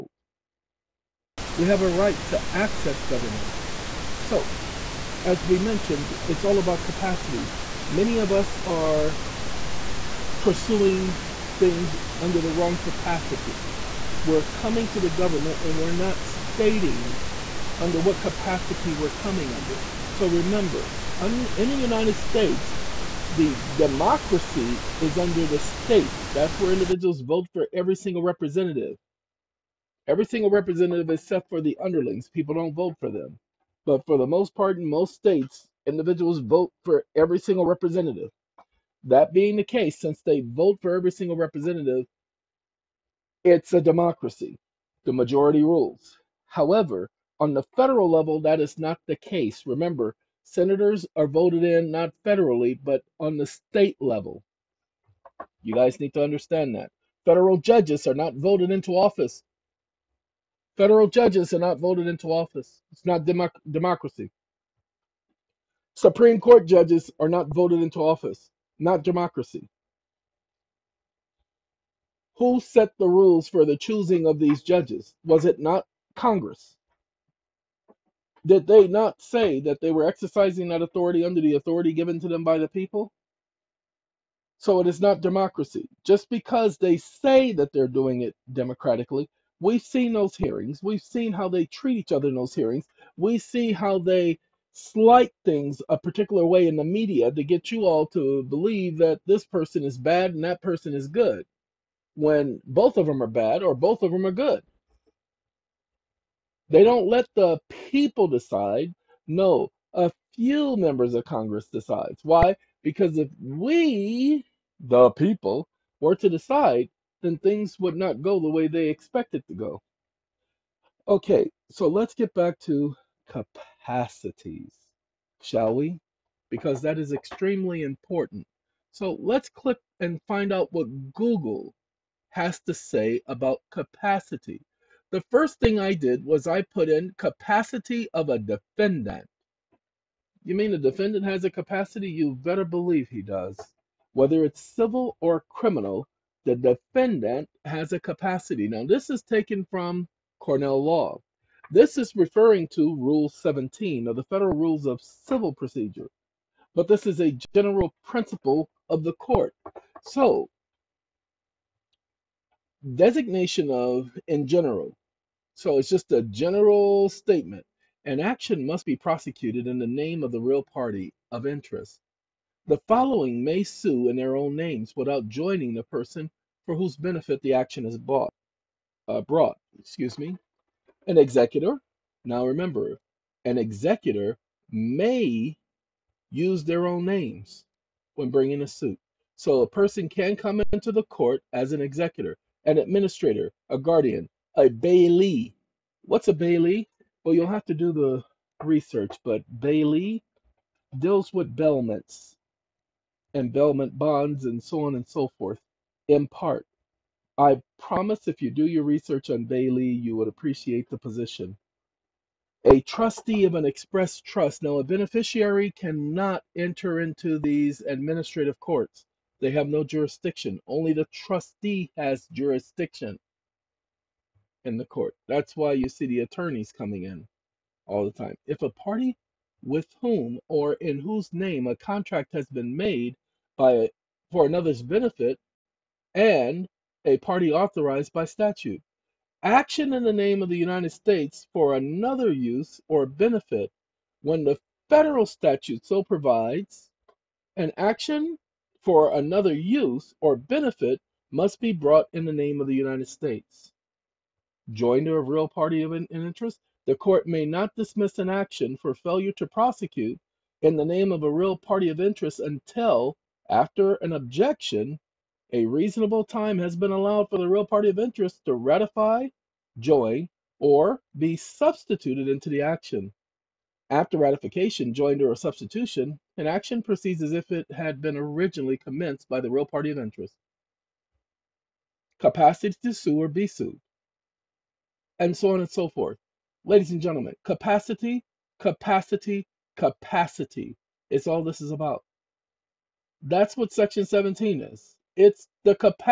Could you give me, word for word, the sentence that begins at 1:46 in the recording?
They don't let the people decide.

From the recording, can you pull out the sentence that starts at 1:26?
Just because they say that they're doing it democratically, we've seen those hearings.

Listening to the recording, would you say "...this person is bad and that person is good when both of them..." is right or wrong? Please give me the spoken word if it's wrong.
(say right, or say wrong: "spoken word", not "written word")
right.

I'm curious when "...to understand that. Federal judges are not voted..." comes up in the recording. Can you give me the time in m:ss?
0:56.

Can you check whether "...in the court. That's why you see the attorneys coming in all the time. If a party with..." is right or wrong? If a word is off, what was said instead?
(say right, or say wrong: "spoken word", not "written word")
right.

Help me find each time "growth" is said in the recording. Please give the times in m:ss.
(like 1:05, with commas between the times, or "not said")
not said.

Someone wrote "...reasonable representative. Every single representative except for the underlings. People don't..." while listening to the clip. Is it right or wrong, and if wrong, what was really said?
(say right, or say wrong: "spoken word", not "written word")
wrong: "single", not "reasonable".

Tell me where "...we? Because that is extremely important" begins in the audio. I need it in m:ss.
2:05.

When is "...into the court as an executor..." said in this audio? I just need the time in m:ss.
3:10.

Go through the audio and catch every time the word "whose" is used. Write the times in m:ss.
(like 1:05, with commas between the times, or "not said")
2:56, 3:50.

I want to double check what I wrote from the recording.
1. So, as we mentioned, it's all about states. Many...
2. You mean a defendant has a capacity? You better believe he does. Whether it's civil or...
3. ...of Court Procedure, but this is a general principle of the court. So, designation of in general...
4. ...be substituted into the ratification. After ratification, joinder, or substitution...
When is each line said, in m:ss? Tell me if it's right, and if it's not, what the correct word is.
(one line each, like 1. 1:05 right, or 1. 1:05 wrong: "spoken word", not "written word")
1. 0:04 wrong: "capacities", not "states"
2. 2:20 right
3. 2:34 wrong: "Civil", not "Court"
4. 4:31 wrong: "action", not "ratification".